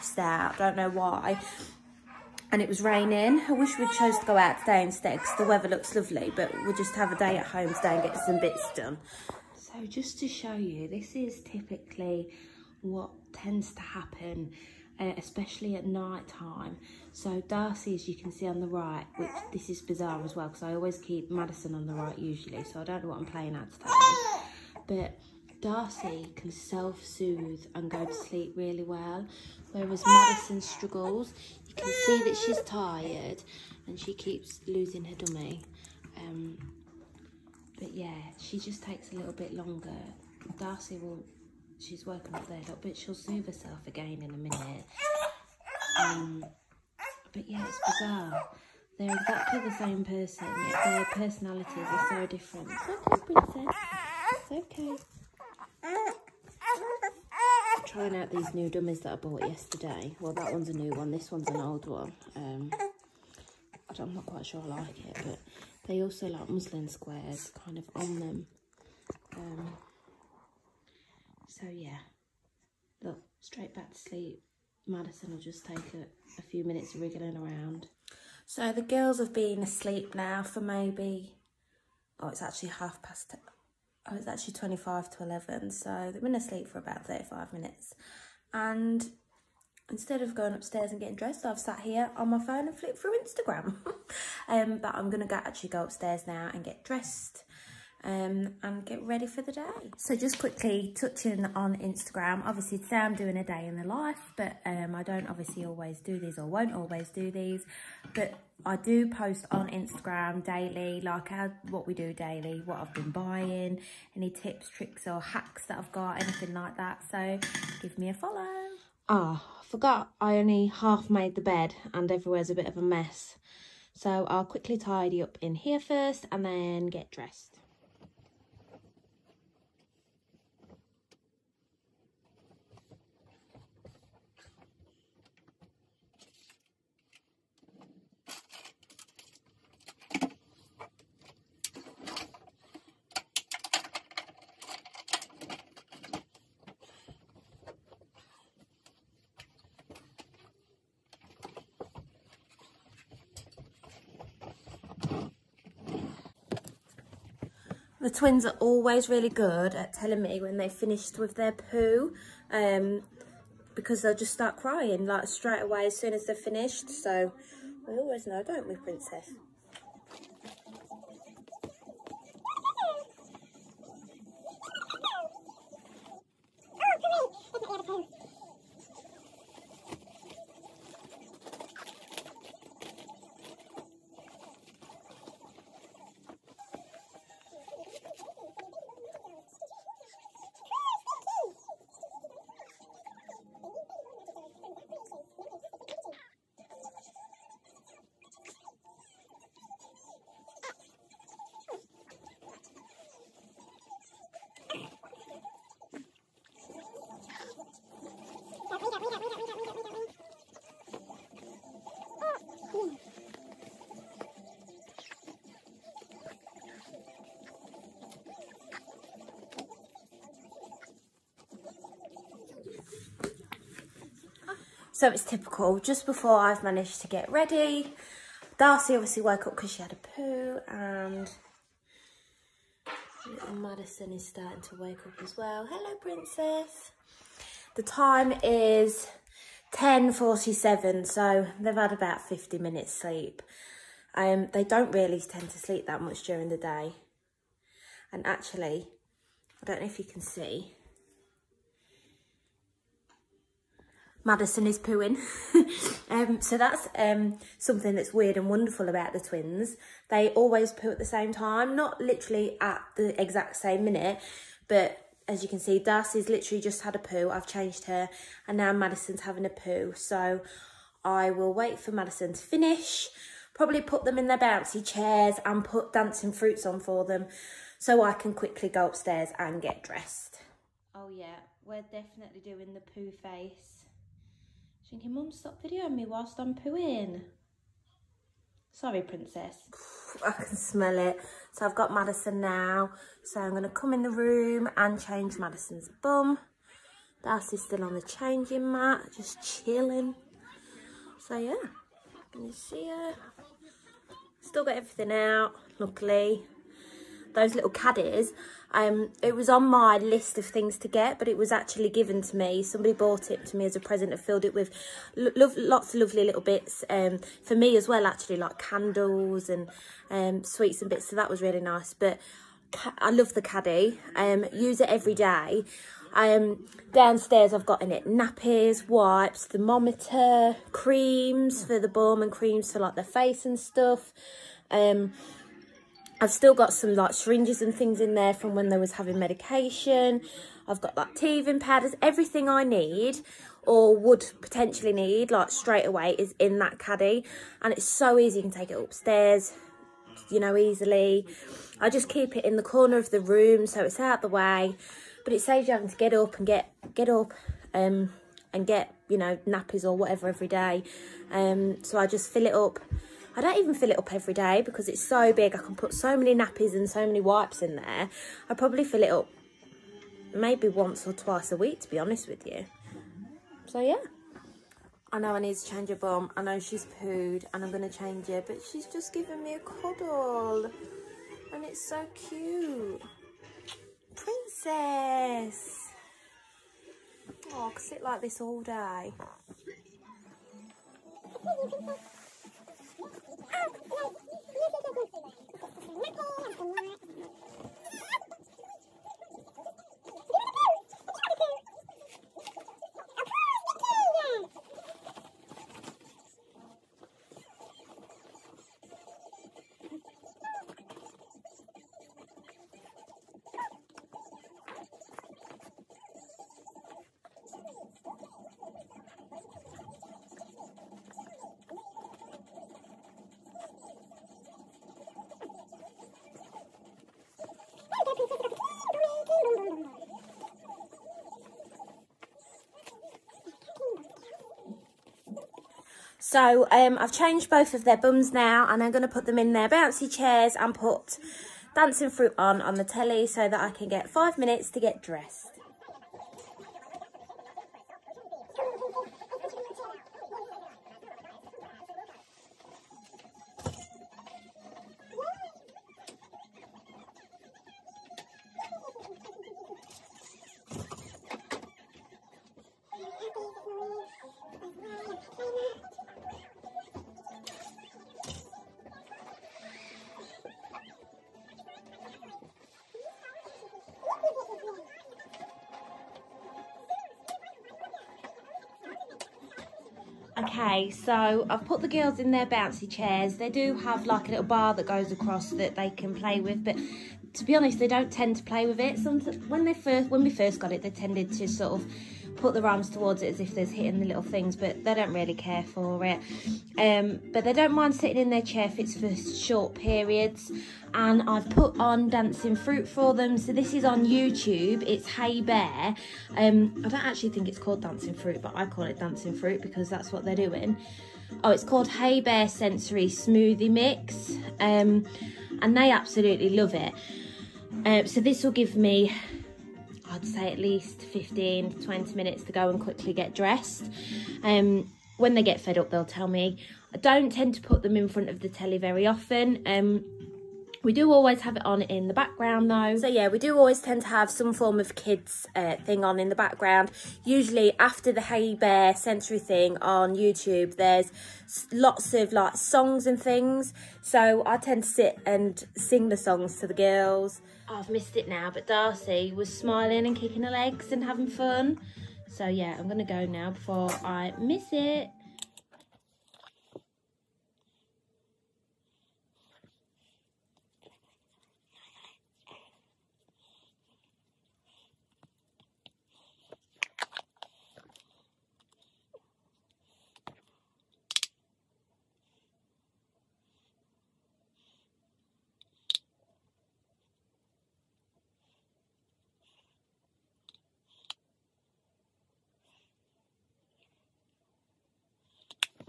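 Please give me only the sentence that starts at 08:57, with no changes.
Usually after the Hey Bear sensory thing on YouTube, there's lots of like songs and things.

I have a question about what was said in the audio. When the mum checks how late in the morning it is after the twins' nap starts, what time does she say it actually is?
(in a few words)
25 to 11.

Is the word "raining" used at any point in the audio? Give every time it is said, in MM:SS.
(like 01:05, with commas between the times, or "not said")
00:02.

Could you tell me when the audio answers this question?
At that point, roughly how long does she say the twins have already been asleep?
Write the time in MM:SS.
01:27.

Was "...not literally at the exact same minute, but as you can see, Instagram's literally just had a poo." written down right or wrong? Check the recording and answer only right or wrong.
wrong.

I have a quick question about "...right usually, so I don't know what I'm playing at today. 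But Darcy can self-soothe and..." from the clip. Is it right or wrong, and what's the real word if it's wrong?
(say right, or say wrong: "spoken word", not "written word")
right.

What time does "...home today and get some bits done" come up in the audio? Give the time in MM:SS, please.
00:07.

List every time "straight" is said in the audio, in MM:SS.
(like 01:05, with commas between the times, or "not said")
01:13, 02:45, 05:45.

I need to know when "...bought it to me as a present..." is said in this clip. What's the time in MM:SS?
05:12.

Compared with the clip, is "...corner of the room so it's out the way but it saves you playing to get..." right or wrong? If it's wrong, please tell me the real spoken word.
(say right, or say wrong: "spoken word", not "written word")
wrong: "having", not "playing".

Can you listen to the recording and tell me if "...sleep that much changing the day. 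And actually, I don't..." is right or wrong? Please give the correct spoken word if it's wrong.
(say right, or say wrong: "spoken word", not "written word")
wrong: "during", not "changing".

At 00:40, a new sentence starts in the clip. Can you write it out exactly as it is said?
Darcy will she's woken up there a little bit.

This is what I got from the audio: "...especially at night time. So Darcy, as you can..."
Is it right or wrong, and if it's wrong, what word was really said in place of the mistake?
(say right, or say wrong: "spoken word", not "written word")
right.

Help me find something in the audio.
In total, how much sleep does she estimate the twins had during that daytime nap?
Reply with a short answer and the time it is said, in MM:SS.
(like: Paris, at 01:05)
50 minutes, at 04:02.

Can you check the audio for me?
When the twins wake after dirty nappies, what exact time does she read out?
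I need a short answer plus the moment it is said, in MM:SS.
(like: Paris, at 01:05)
10.47, at 03:59.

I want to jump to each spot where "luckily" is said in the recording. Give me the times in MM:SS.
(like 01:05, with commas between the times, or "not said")
05:05.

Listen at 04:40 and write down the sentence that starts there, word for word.
Oh yeah, we're definitely doing the poo face.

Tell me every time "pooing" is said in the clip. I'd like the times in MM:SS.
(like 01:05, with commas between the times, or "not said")
04:14, 04:46.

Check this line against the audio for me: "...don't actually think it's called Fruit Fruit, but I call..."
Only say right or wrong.
wrong.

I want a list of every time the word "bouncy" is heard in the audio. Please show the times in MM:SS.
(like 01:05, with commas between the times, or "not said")
04:34, 07:19, 08:02.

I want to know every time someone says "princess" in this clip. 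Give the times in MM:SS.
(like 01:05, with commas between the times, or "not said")
00:53, 02:48, 03:55, 04:49, 06:24.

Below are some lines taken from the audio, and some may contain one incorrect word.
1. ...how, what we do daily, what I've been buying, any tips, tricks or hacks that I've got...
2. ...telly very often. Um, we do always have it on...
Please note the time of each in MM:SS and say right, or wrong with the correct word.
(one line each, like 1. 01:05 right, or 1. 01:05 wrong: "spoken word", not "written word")
1. 01:51 right
2. 08:48 right.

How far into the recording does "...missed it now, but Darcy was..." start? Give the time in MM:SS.
09:07.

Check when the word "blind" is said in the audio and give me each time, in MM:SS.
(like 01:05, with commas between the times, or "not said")
not said.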